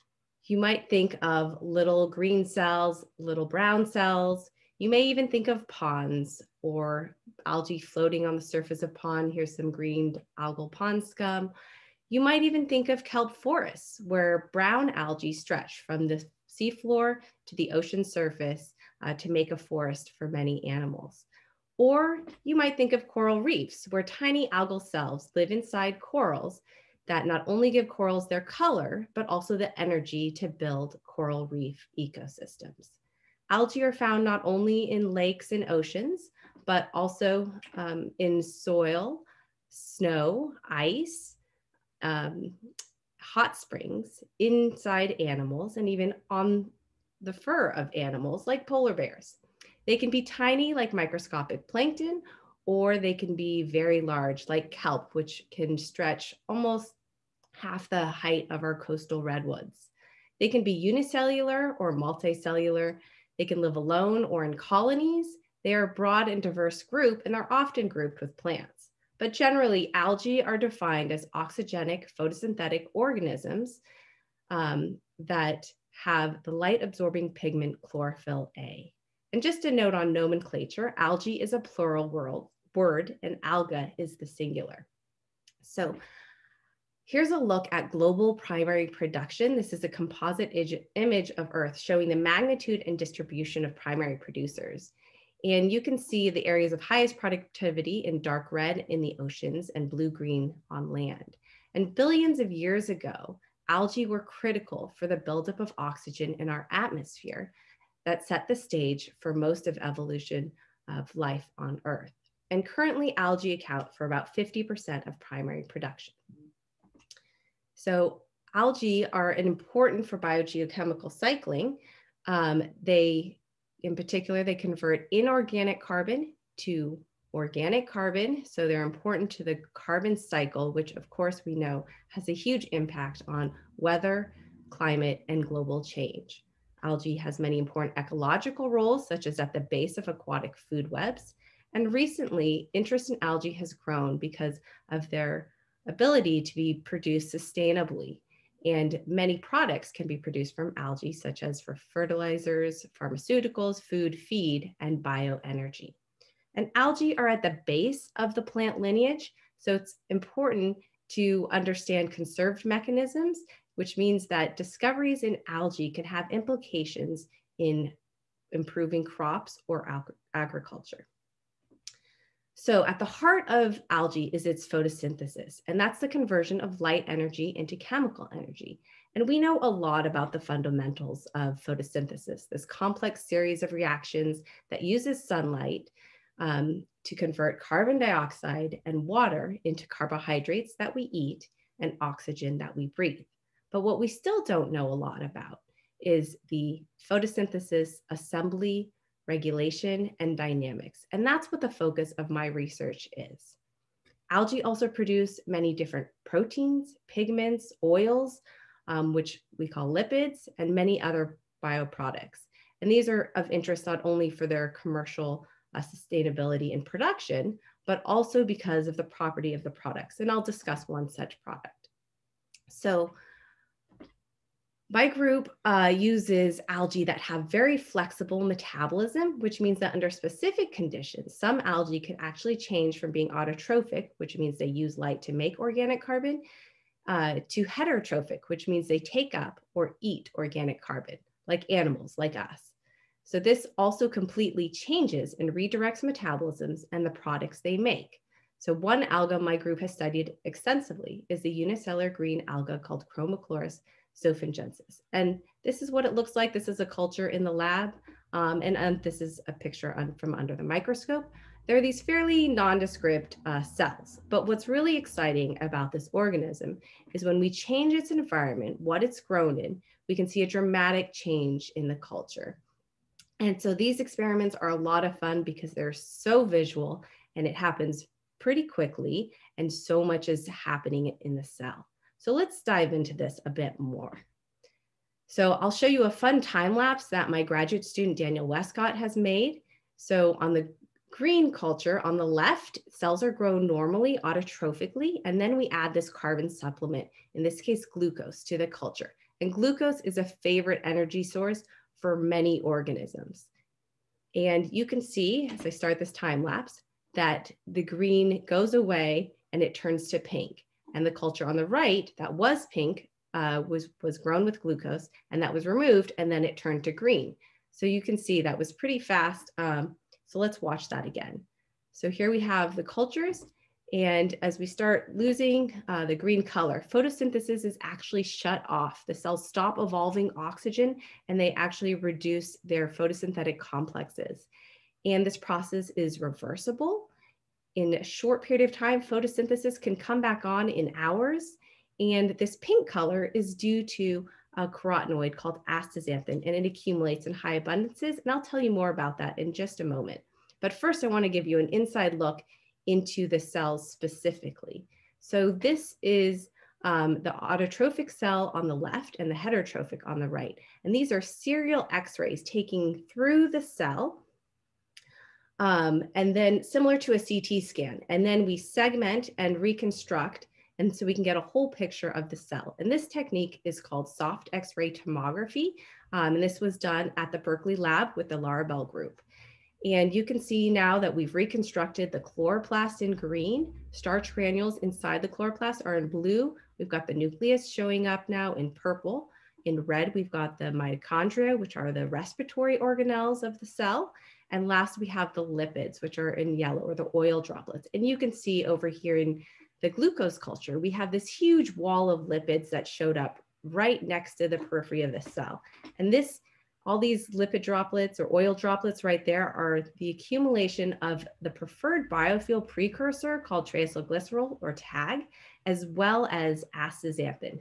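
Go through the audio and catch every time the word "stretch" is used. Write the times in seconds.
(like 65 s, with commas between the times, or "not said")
15 s, 55 s.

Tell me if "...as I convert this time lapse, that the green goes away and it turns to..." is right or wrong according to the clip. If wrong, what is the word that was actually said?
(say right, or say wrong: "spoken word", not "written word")
wrong: "start", not "convert".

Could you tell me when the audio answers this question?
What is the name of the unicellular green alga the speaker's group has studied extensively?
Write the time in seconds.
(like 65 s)
253 s.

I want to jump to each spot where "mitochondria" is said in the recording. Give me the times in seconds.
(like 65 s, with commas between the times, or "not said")
390 s.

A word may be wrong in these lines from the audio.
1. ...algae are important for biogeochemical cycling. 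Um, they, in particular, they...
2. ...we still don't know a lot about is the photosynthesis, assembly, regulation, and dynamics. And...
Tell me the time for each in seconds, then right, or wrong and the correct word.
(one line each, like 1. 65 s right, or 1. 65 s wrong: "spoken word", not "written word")
1. 118 s right
2. 193 s right.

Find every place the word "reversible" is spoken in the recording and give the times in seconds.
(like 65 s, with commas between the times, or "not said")
336 s.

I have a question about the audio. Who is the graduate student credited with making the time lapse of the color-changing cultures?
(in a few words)
Daniel Westcott.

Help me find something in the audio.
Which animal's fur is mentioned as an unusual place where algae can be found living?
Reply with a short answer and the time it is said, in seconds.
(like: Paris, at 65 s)
polar bears, at 48 s.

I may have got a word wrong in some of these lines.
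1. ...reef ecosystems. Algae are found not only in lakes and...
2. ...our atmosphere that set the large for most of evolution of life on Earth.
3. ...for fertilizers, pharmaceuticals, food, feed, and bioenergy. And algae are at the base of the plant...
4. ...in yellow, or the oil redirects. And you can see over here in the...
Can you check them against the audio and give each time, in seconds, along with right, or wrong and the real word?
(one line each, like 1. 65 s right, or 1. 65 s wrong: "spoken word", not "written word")
1. 31 s right
2. 106 s wrong: "stage", not "large"
3. 151 s right
4. 396 s wrong: "droplets", not "redirects".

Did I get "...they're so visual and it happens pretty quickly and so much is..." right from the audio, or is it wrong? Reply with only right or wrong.
right.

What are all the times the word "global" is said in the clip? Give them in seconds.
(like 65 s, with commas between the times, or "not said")
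87 s, 135 s.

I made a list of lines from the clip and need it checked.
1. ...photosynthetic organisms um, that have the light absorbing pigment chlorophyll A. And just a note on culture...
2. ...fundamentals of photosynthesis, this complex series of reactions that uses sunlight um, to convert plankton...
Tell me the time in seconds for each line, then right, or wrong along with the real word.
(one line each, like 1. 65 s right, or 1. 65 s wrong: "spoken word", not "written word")
1. 72 s wrong: "nomenclature", not "culture"
2. 180 s wrong: "carbon", not "plankton".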